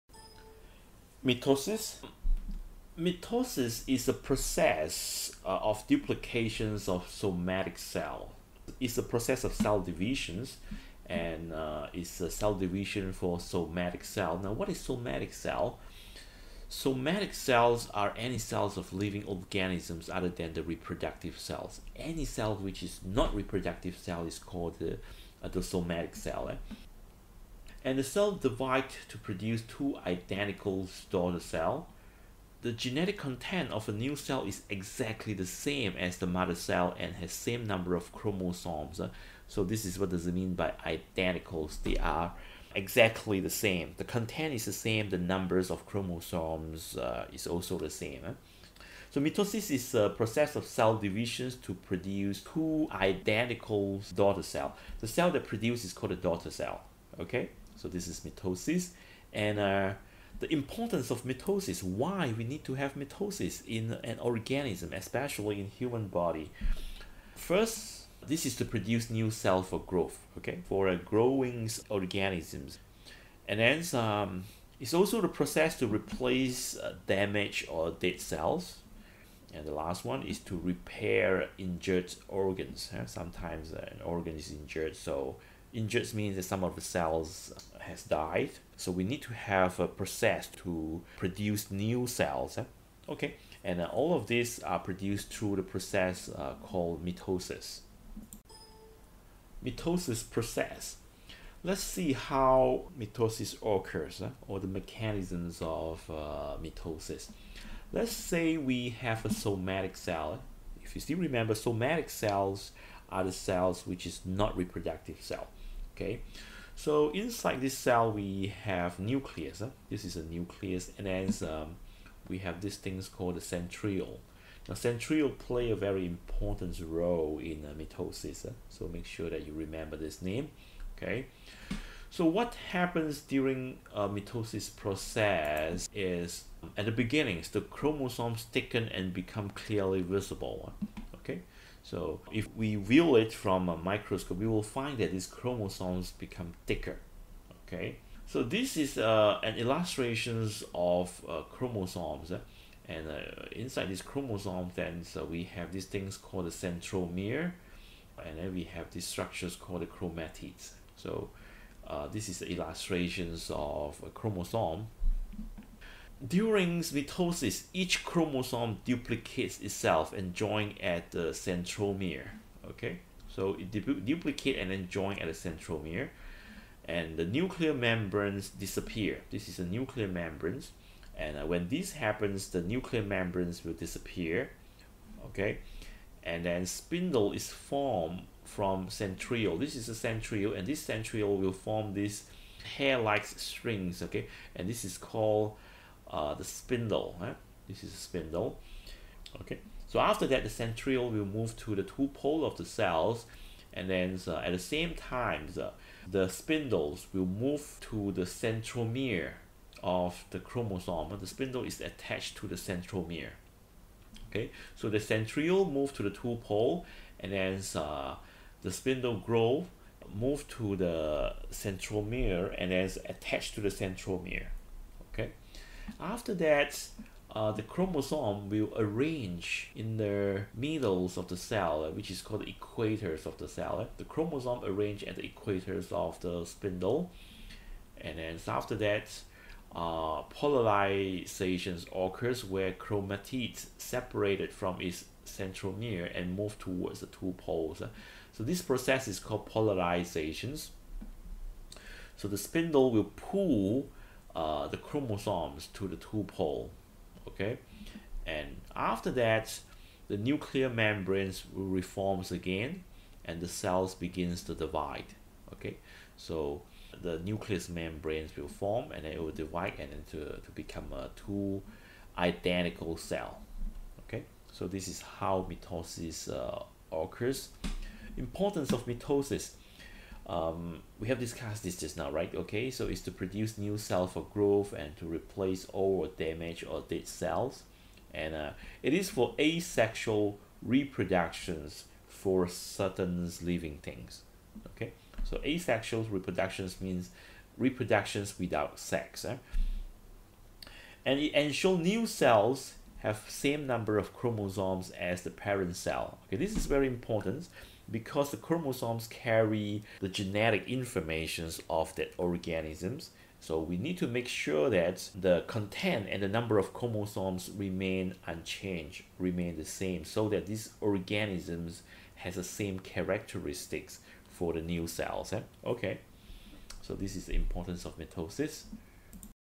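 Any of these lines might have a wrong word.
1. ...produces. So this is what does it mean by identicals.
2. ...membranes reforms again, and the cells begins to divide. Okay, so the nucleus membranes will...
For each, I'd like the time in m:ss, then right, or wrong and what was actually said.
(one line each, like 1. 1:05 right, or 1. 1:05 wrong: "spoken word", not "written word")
1. 0:38 wrong: "chromosomes", not "produces"
2. 4:20 right.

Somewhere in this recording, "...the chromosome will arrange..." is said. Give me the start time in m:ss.
3:47.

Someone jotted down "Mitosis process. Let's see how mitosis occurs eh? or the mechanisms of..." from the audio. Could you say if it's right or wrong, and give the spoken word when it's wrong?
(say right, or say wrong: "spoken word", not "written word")
right.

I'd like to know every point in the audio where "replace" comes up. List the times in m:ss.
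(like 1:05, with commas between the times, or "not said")
1:15, 4:45.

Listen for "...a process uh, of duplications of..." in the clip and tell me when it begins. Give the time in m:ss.
0:04.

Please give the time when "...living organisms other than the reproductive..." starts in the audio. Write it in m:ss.
0:18.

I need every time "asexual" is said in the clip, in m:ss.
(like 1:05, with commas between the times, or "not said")
4:49, 4:55.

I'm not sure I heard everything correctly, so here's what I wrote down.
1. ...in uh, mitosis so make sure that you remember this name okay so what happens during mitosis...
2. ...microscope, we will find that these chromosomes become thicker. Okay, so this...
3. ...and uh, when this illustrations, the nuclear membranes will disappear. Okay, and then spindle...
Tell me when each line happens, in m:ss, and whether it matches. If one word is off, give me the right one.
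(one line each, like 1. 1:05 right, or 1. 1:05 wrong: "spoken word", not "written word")
1. 2:07 right
2. 2:23 right
3. 3:01 wrong: "happens", not "illustrations".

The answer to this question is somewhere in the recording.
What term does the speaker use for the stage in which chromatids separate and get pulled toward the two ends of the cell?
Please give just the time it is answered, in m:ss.
4:09.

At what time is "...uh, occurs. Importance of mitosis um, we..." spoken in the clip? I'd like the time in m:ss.
4:36.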